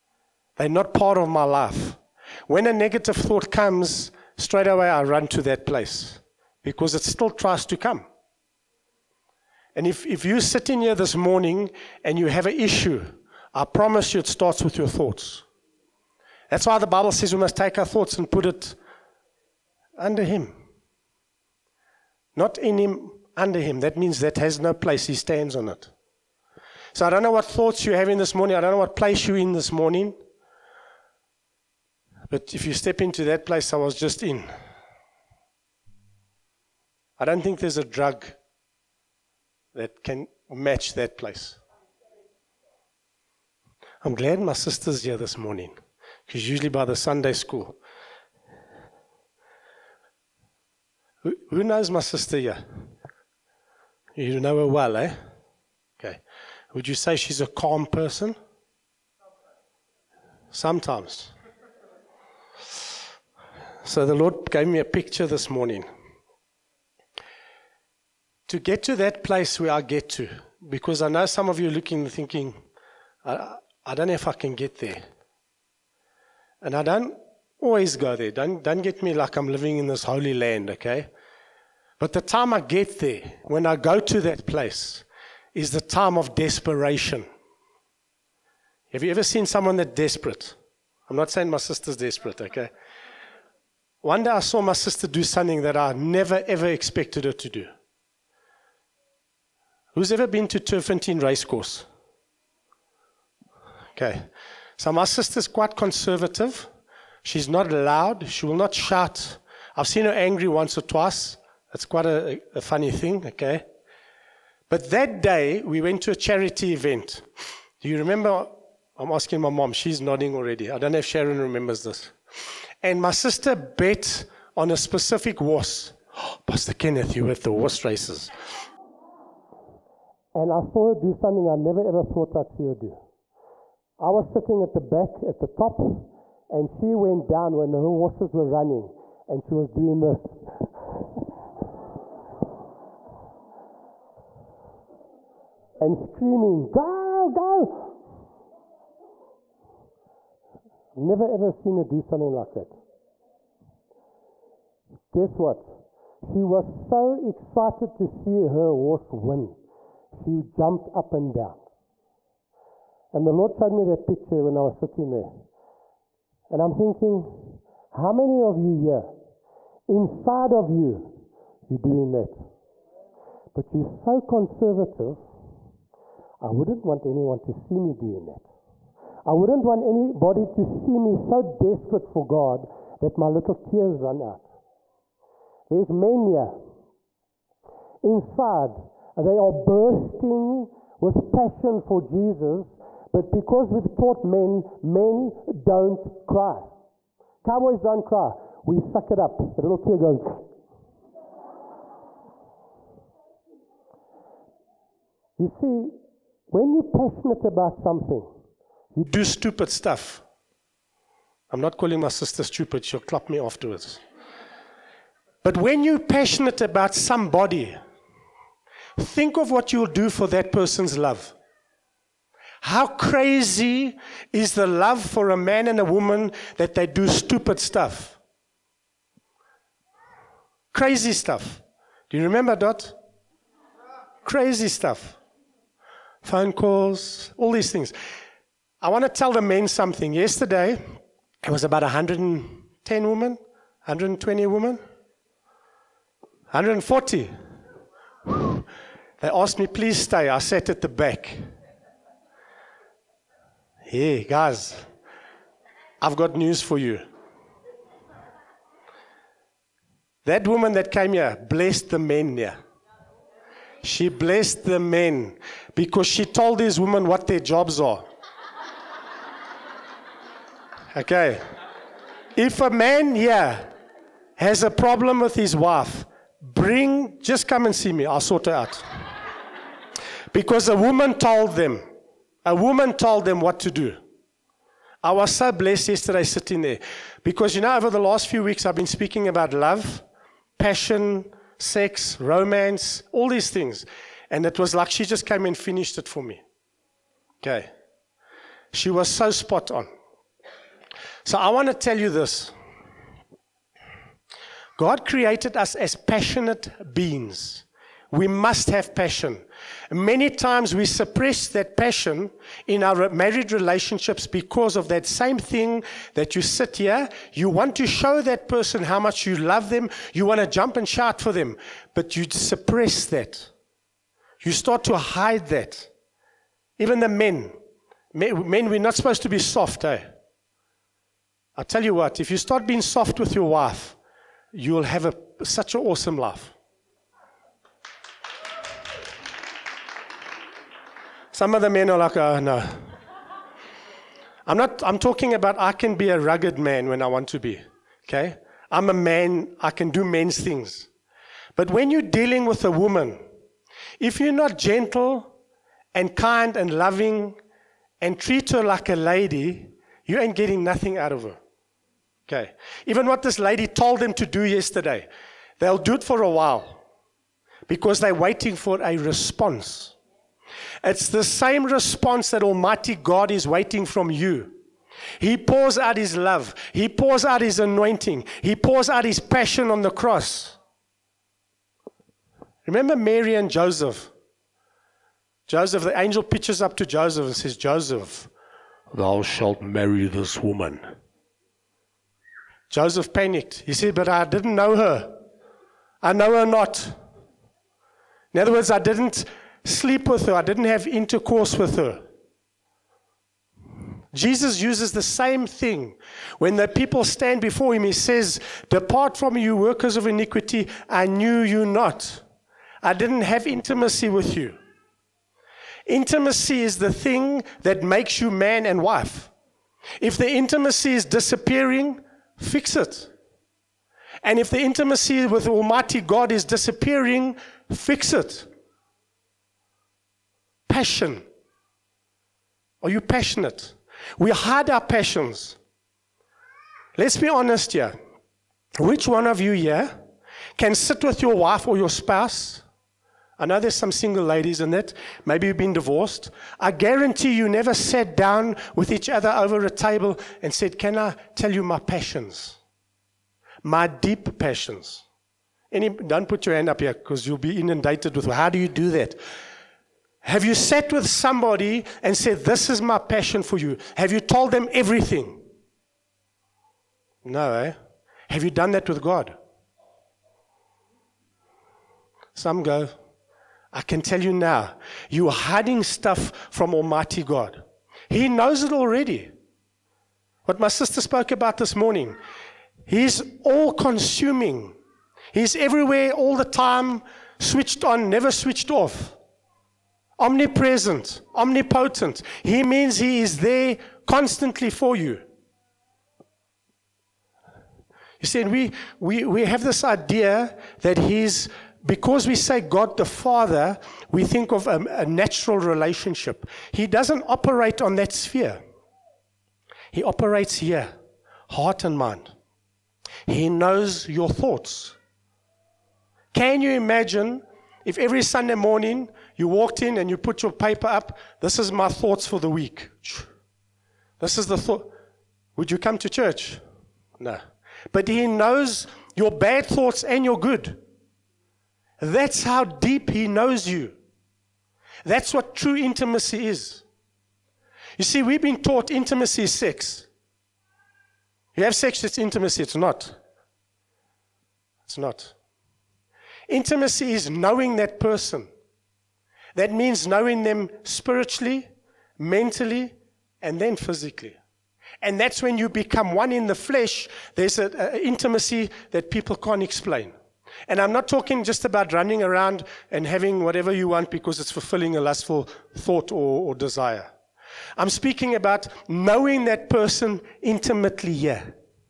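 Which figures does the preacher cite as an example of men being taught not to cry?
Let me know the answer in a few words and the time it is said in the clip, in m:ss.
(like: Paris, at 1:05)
Cowboys, at 3:17.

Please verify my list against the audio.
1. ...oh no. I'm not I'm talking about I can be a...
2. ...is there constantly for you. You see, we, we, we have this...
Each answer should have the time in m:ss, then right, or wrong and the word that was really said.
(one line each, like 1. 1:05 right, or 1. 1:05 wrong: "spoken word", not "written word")
1. 5:42 right
2. 8:13 right.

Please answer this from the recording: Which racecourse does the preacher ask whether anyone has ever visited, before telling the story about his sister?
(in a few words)
Turffontein Racecourse.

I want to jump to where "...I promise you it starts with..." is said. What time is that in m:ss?
0:13.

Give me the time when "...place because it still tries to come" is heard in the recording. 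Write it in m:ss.
0:05.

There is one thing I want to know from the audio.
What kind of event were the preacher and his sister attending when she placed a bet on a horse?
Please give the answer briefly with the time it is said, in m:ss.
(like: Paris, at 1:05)
Charity event, at 1:56.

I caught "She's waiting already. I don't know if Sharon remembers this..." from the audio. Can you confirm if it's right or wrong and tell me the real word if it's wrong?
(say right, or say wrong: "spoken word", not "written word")
wrong: "nodding", not "waiting".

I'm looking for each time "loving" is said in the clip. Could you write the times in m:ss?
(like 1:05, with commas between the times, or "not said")
5:56.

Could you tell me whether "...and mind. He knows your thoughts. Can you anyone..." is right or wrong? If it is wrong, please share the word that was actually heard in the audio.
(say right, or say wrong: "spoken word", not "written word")
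wrong: "imagine", not "anyone".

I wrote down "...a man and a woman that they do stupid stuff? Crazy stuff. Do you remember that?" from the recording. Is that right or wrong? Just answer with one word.
right.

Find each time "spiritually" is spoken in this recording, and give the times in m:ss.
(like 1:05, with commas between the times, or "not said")
9:10.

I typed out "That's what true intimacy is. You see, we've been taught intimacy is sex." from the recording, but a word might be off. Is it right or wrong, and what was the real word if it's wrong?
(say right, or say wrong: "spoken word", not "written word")
right.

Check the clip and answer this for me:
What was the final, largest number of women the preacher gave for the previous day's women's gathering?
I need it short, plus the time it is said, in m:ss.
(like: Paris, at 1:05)
140, at 4:06.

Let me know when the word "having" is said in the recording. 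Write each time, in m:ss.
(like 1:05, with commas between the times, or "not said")
0:27, 9:23.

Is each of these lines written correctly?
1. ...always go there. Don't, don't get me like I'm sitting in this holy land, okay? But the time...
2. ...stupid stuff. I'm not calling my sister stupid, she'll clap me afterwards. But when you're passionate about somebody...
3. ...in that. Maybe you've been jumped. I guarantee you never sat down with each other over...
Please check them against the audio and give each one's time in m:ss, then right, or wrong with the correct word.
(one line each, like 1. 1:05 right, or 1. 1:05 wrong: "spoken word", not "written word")
1. 1:17 wrong: "living", not "sitting"
2. 3:29 right
3. 7:24 wrong: "divorced", not "jumped".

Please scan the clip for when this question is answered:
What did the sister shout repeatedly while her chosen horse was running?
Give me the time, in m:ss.
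2:26.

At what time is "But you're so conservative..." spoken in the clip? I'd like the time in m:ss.
2:53.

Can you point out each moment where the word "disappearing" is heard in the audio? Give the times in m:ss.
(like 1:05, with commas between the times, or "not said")
7:01, 7:06.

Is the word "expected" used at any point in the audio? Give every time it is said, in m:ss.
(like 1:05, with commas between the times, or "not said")
1:36.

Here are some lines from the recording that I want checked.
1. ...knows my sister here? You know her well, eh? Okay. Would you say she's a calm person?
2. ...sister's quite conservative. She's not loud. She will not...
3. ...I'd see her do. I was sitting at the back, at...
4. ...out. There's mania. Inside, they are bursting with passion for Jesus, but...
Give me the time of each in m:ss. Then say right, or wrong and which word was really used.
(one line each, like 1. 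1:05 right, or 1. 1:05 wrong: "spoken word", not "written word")
1. 0:51 right
2. 1:45 right
3. 2:12 right
4. 3:04 right.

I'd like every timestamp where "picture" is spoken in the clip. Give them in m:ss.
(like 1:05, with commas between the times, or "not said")
1:04, 2:44.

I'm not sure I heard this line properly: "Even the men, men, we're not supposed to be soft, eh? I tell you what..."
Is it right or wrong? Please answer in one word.
right.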